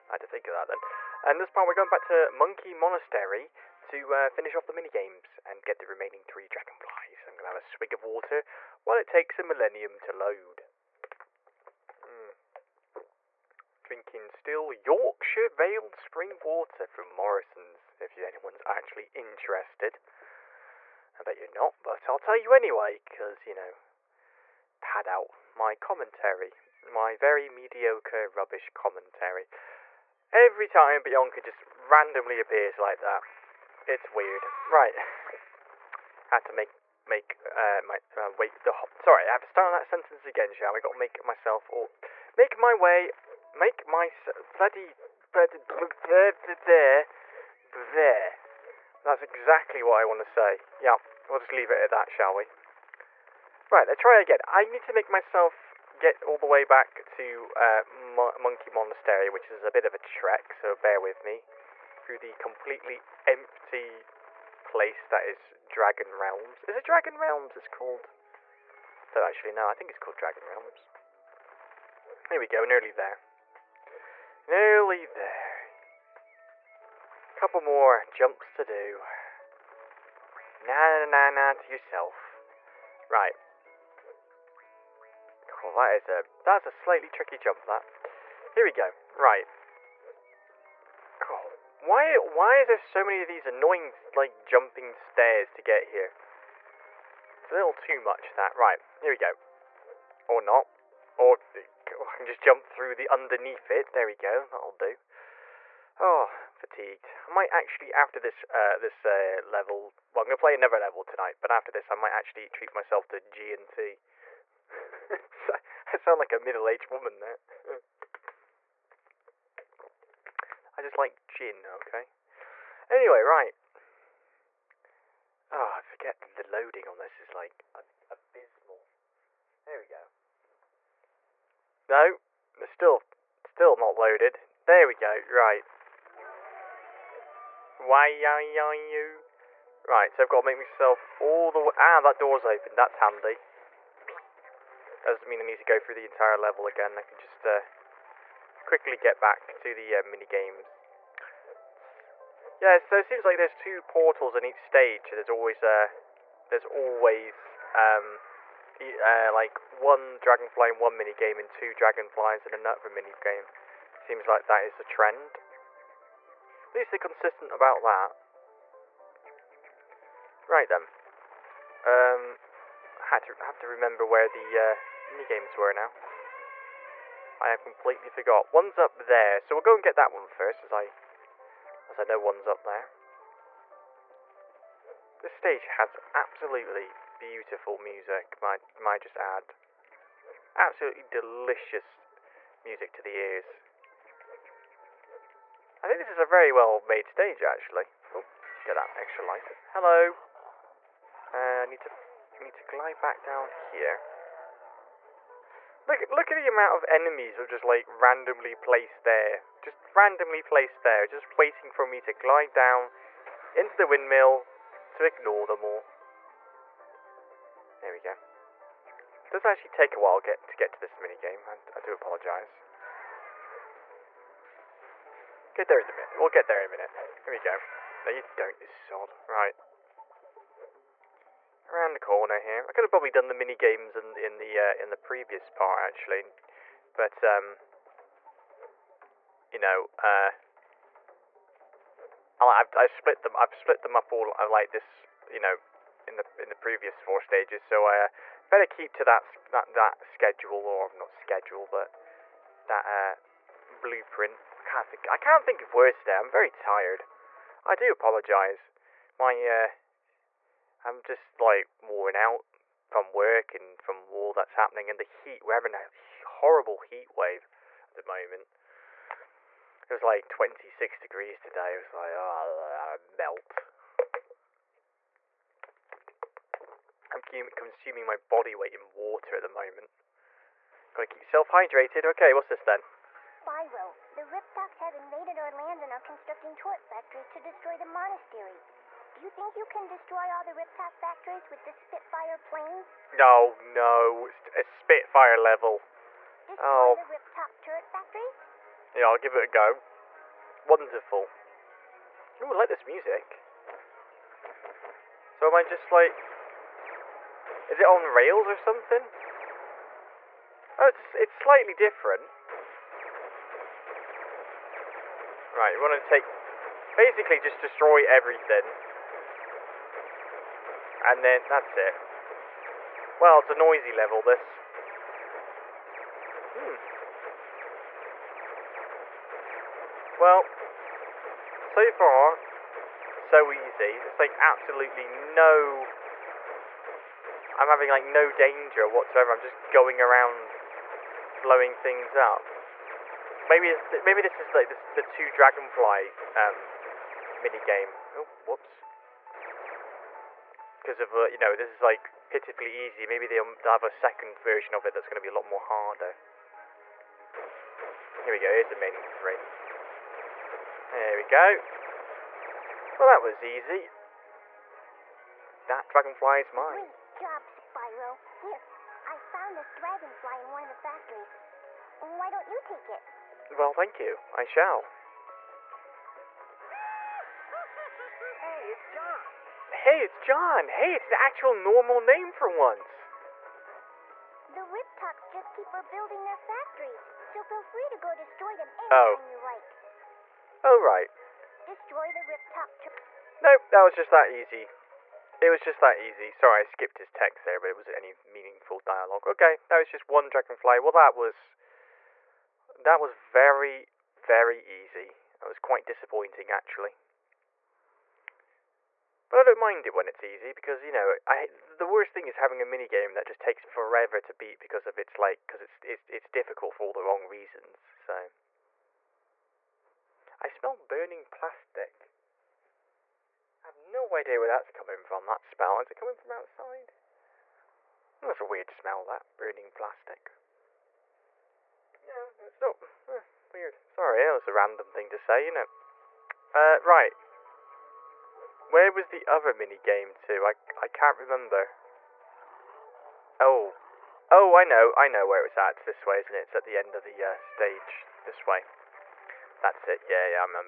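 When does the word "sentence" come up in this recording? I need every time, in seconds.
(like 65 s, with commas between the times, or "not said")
39 s.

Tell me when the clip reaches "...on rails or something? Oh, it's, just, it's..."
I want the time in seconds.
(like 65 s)
307 s.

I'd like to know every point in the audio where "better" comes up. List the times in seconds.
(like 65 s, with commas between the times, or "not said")
248 s.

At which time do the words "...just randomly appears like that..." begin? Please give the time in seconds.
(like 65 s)
31 s.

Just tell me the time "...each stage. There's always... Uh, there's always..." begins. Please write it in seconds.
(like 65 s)
154 s.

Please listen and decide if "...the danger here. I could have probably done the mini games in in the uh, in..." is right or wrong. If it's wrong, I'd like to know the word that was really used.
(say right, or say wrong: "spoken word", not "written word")
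wrong: "corner", not "danger".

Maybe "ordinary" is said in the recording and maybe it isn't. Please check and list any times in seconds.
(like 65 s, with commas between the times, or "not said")
not said.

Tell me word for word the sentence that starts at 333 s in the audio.
It's like absolutely no I'm having like no danger whatsoever.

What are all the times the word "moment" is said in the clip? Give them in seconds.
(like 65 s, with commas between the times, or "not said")
268 s, 279 s.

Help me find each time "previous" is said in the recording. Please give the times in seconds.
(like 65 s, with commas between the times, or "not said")
234 s, 246 s.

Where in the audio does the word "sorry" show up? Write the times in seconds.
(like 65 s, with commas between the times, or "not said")
38 s, 396 s, 433 s.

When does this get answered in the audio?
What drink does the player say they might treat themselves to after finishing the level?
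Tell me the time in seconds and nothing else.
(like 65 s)
113 s.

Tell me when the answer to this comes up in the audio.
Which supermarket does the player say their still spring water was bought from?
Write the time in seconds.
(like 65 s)
17 s.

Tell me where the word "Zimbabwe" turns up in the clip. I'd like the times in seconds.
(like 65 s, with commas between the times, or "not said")
not said.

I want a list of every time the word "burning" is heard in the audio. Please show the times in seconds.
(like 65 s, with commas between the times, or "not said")
420 s, 429 s.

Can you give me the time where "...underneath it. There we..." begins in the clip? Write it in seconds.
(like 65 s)
103 s.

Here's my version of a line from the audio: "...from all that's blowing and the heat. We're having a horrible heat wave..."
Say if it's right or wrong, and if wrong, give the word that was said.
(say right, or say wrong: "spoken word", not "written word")
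wrong: "happening", not "blowing".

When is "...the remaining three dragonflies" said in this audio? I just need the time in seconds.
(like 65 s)
5 s.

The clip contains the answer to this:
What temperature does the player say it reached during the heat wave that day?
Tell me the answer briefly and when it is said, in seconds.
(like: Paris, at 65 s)
26 degrees, at 270 s.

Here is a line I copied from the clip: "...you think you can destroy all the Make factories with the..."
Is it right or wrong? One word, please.
wrong.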